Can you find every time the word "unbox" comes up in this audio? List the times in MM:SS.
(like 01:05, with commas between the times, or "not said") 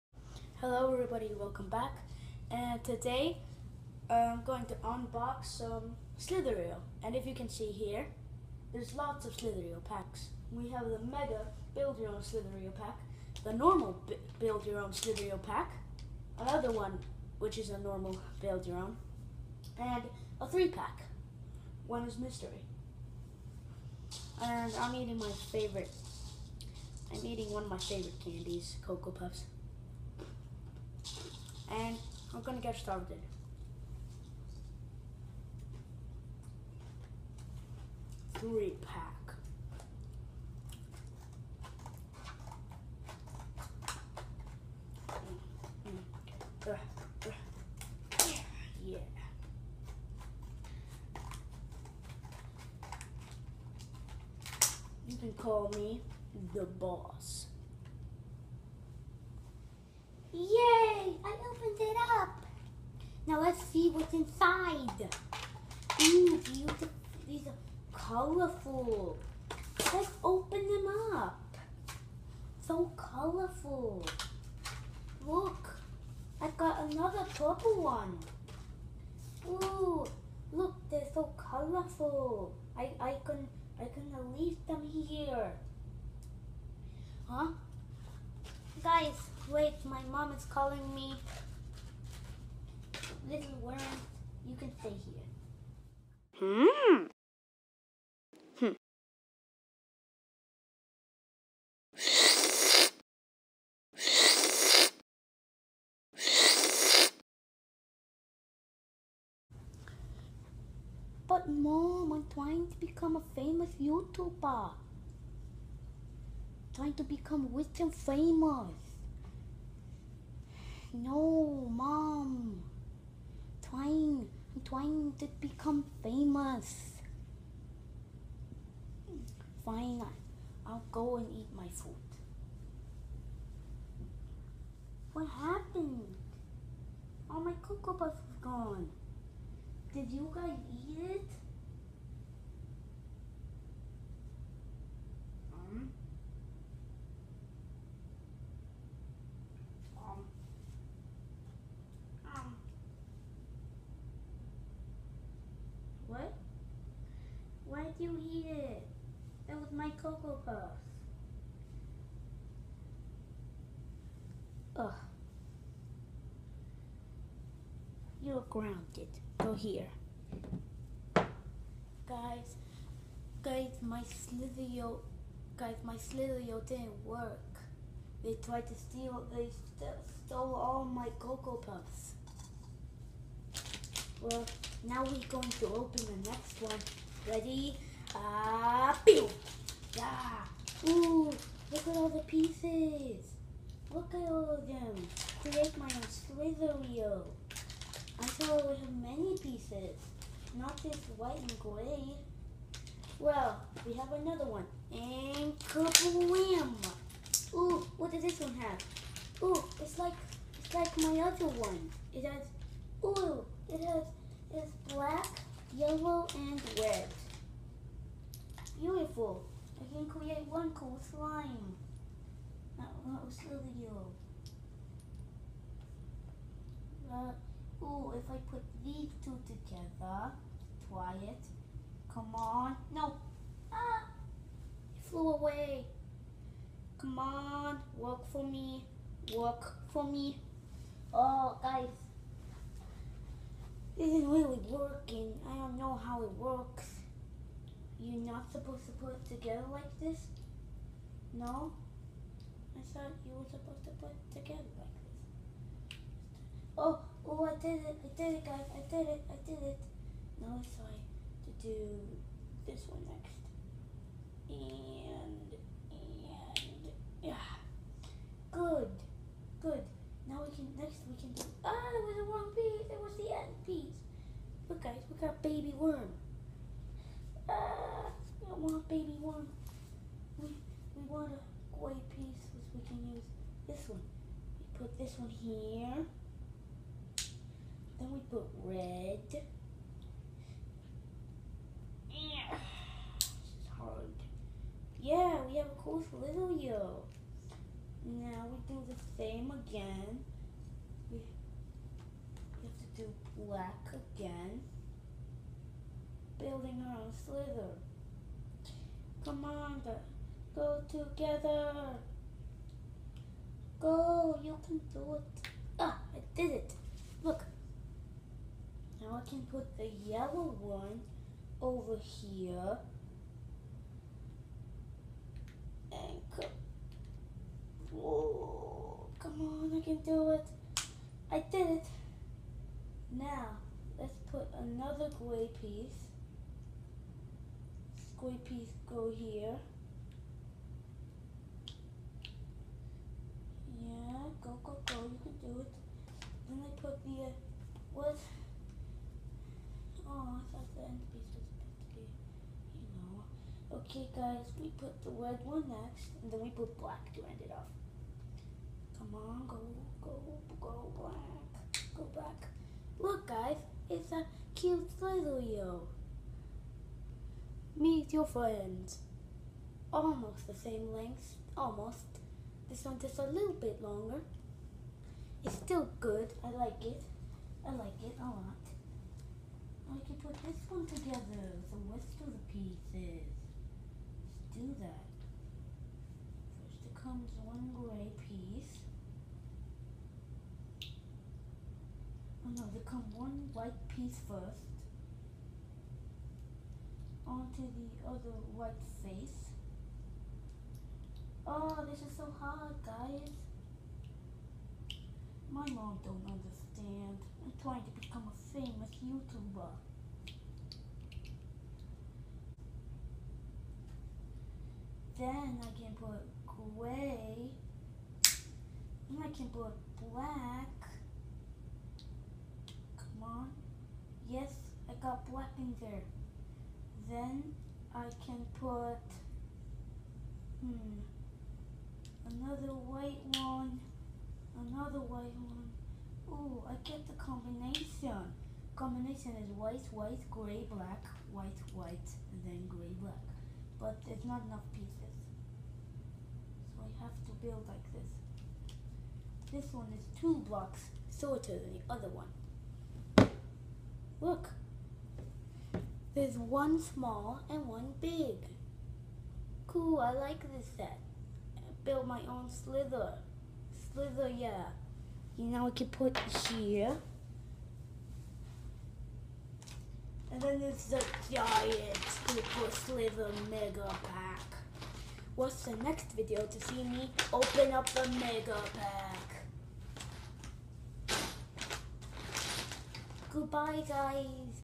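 00:04.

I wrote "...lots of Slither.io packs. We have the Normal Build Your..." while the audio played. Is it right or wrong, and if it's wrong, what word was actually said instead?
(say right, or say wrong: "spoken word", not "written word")
wrong: "Mega", not "Normal".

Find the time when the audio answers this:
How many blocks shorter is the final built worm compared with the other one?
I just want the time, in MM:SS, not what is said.
07:30.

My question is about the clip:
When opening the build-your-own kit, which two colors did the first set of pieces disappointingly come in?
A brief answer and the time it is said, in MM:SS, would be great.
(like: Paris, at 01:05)
white and gray, at 03:21.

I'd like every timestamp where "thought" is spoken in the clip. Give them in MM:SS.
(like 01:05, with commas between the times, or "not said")
03:18, 04:12, 05:50.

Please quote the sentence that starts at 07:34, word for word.
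Look, one small and one big.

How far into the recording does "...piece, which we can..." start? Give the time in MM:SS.
04:42.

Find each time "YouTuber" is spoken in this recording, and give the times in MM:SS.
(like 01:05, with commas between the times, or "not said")
01:53, 06:49.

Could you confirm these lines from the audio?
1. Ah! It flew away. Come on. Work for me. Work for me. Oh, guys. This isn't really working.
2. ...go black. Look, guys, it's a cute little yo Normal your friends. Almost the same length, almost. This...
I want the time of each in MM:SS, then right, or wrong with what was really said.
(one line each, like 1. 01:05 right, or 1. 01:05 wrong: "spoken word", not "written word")
1. 03:53 right
2. 06:01 wrong: "Meet", not "Normal".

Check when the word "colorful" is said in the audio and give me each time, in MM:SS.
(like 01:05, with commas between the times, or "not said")
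01:07, 01:12, 01:21.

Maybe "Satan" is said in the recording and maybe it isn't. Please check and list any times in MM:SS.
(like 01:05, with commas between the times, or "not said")
not said.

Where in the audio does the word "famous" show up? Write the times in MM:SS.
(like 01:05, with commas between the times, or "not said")
01:53, 01:57, 02:06, 06:48.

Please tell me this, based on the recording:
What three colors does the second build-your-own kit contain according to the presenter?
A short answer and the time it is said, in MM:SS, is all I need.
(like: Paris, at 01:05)
black, yellow, and red, at 03:34.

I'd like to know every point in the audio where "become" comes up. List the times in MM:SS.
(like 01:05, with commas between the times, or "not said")
01:52, 01:57, 02:05, 06:47.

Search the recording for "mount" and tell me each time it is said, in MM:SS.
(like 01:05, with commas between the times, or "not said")
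not said.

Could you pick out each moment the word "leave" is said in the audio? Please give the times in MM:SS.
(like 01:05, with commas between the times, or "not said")
01:24.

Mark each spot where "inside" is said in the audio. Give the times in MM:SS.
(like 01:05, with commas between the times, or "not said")
01:04.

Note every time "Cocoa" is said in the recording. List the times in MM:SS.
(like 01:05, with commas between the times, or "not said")
00:28, 02:17, 02:40, 03:01.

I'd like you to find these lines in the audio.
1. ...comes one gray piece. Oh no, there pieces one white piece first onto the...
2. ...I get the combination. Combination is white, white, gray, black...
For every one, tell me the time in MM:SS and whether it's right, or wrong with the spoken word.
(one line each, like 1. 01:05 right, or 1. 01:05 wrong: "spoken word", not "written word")
1. 06:26 wrong: "comes", not "pieces"
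2. 07:16 right.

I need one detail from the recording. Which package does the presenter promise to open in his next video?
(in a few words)
the giant super slither mega pack.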